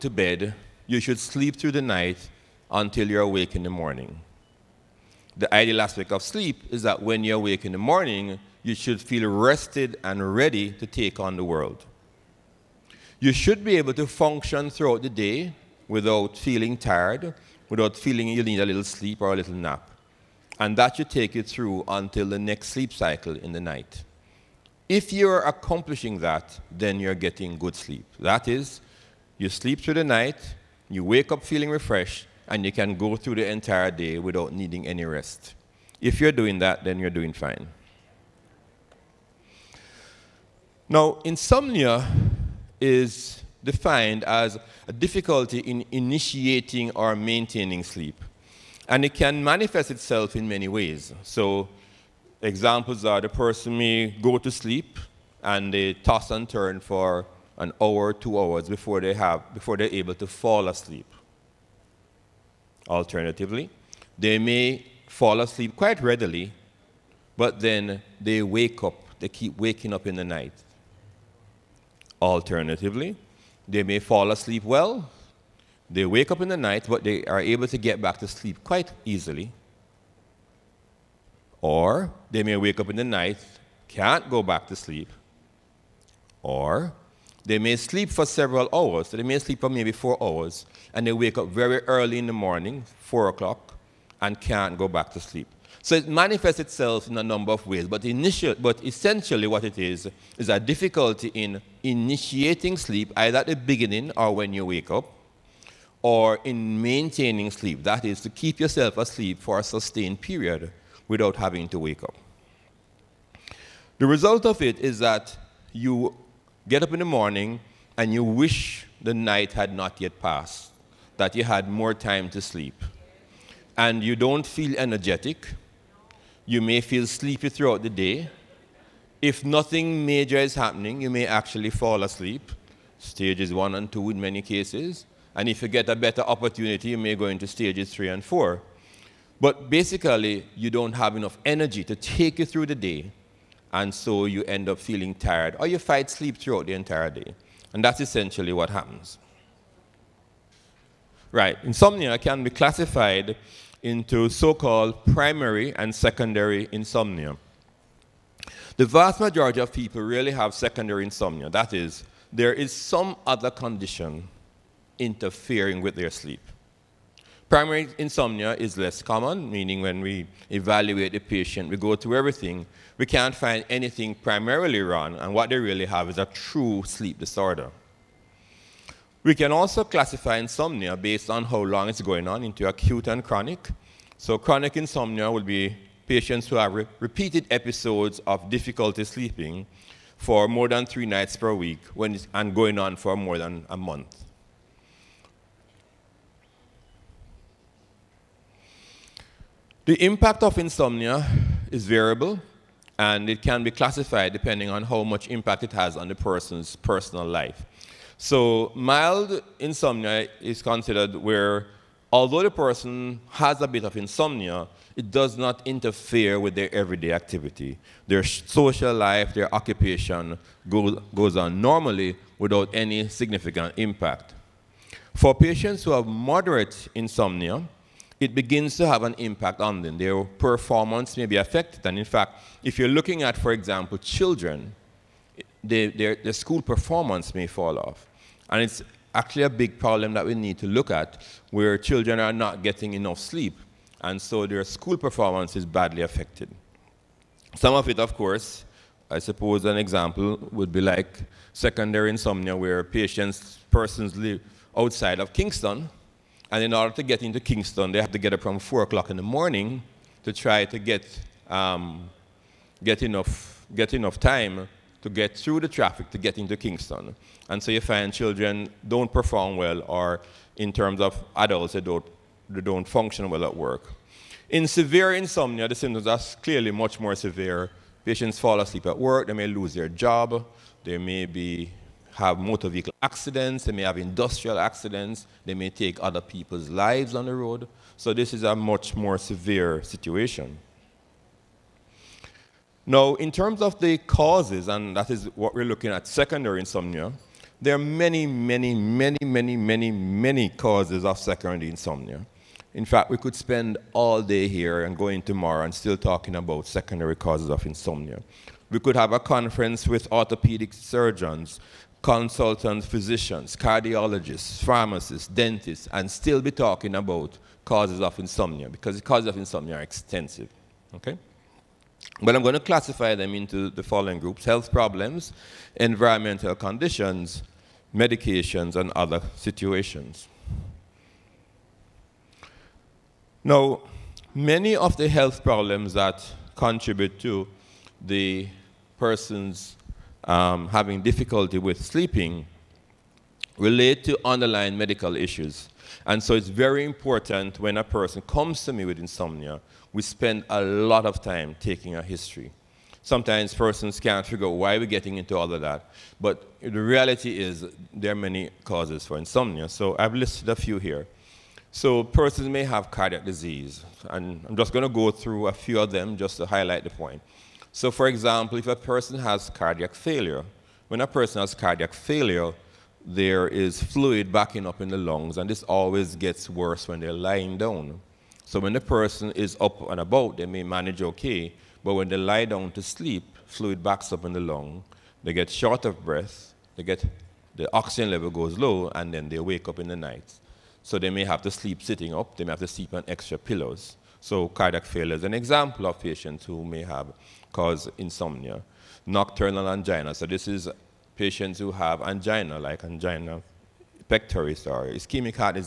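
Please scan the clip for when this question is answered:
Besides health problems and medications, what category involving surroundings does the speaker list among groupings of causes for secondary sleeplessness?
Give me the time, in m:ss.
5:25.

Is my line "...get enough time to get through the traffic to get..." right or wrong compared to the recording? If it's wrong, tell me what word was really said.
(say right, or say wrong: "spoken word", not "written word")
right.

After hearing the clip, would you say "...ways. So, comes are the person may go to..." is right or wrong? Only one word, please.
wrong.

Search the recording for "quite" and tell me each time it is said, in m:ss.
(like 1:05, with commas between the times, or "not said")
1:05, 1:18.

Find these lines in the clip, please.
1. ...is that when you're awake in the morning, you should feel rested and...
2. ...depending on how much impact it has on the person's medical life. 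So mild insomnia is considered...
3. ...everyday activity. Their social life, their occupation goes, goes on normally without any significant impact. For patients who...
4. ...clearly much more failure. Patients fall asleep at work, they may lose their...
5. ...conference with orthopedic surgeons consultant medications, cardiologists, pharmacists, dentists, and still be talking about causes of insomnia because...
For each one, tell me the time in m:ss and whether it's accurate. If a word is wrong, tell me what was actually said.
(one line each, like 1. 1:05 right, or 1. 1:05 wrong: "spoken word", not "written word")
1. 0:06 right
2. 3:24 wrong: "personal", not "medical"
3. 3:36 right
4. 4:36 wrong: "severe", not "failure"
5. 5:09 wrong: "physicians", not "medications".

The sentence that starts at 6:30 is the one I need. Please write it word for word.
So they may have to sleep sitting up, they may have to sleep on extra pillows.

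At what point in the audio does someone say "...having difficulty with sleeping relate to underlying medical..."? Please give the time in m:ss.
5:40.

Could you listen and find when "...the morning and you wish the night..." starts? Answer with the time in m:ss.
1:56.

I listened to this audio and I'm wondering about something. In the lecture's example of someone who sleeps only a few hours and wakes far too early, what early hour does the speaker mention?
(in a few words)
4 o'clock.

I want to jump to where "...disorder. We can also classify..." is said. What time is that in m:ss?
2:57.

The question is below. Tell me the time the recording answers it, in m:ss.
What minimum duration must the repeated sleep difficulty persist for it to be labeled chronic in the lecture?
3:13.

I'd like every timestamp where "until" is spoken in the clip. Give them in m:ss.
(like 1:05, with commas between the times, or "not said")
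0:02, 0:21.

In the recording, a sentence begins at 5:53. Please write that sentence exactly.
Sometimes persons can't figure out why we're getting into all of that, but the reality is there are many causes for insomnia.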